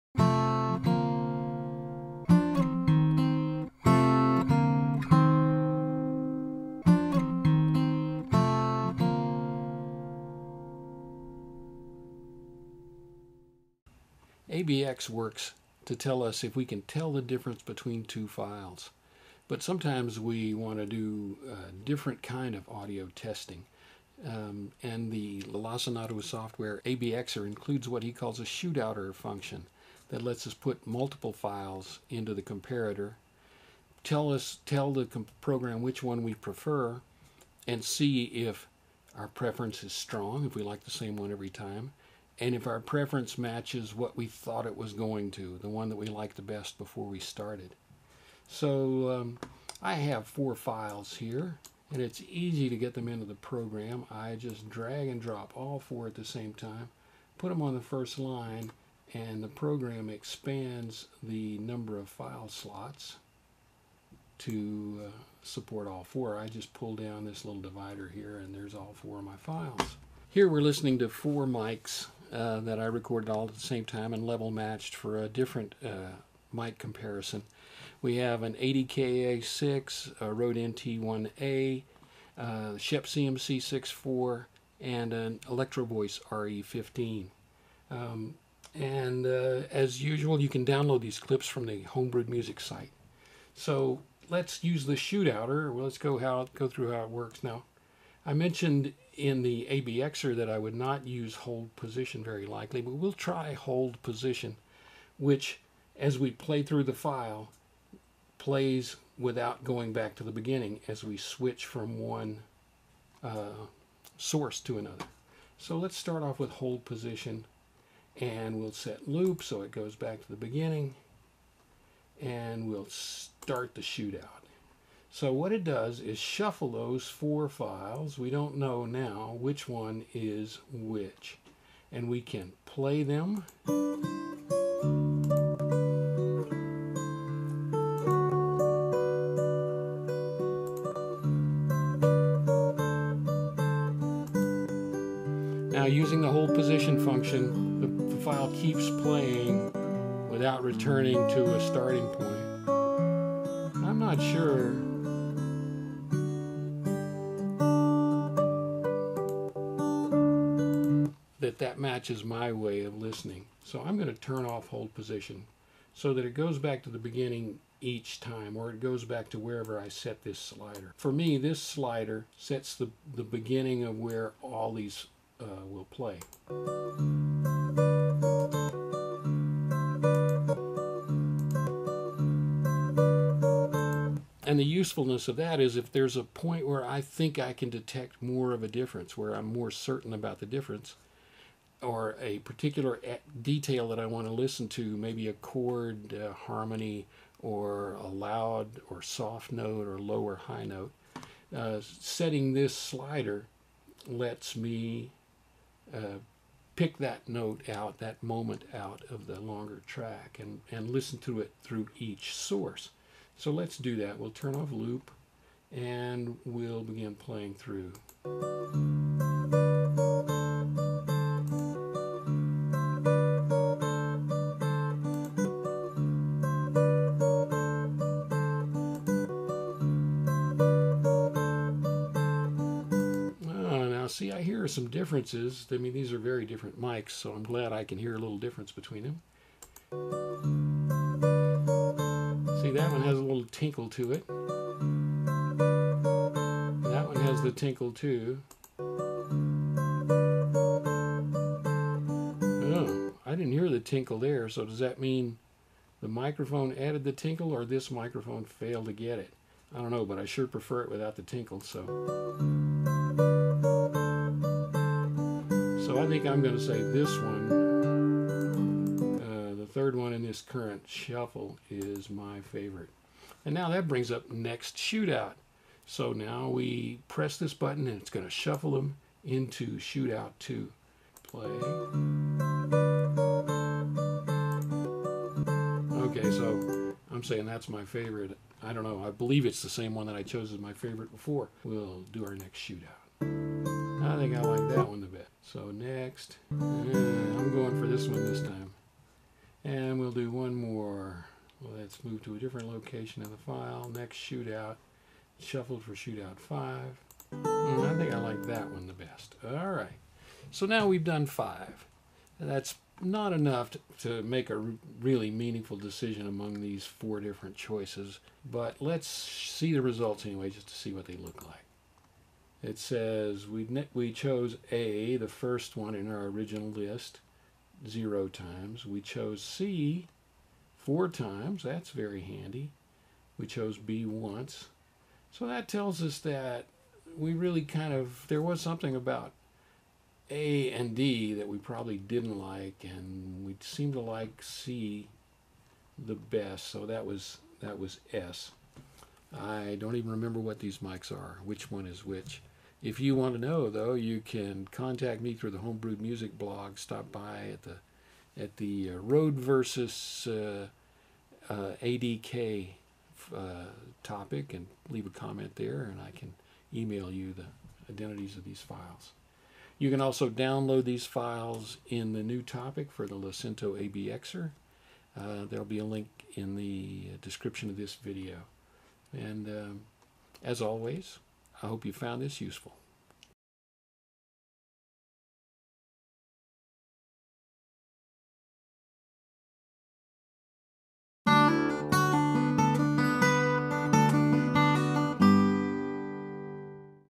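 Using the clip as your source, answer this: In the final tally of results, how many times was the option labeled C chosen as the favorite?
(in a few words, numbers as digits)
4.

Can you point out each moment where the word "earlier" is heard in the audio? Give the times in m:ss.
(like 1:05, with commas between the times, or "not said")
not said.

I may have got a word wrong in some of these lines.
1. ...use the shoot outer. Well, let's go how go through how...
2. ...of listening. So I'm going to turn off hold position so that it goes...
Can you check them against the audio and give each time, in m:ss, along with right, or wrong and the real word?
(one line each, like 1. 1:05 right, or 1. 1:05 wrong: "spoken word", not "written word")
1. 1:34 right
2. 2:42 right.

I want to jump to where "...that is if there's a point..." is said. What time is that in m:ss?
3:05.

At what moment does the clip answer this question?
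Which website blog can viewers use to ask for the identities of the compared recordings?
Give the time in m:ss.
5:55.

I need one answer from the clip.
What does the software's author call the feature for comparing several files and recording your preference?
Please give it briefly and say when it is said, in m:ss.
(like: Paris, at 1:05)
shootouter, at 0:28.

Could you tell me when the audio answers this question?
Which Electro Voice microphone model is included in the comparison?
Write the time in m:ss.
1:25.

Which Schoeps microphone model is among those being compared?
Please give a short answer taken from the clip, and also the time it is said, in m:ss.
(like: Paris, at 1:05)
CMC64, at 1:22.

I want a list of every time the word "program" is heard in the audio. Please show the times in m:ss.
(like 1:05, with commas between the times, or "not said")
0:35, 0:53, 0:59.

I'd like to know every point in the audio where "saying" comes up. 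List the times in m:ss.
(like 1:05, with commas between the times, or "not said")
4:47.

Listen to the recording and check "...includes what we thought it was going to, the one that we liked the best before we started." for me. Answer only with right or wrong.
wrong.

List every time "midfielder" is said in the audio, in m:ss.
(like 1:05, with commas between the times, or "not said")
not said.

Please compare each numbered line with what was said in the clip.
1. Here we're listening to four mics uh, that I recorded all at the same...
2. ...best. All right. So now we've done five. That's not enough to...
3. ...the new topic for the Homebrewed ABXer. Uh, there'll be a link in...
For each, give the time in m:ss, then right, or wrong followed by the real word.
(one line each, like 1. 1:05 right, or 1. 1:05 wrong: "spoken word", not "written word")
1. 1:10 right
2. 5:08 right
3. 6:12 wrong: "Lacinato", not "Homebrewed".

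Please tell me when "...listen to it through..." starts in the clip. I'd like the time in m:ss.
3:30.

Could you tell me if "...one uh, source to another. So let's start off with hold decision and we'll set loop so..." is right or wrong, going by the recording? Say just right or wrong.
wrong.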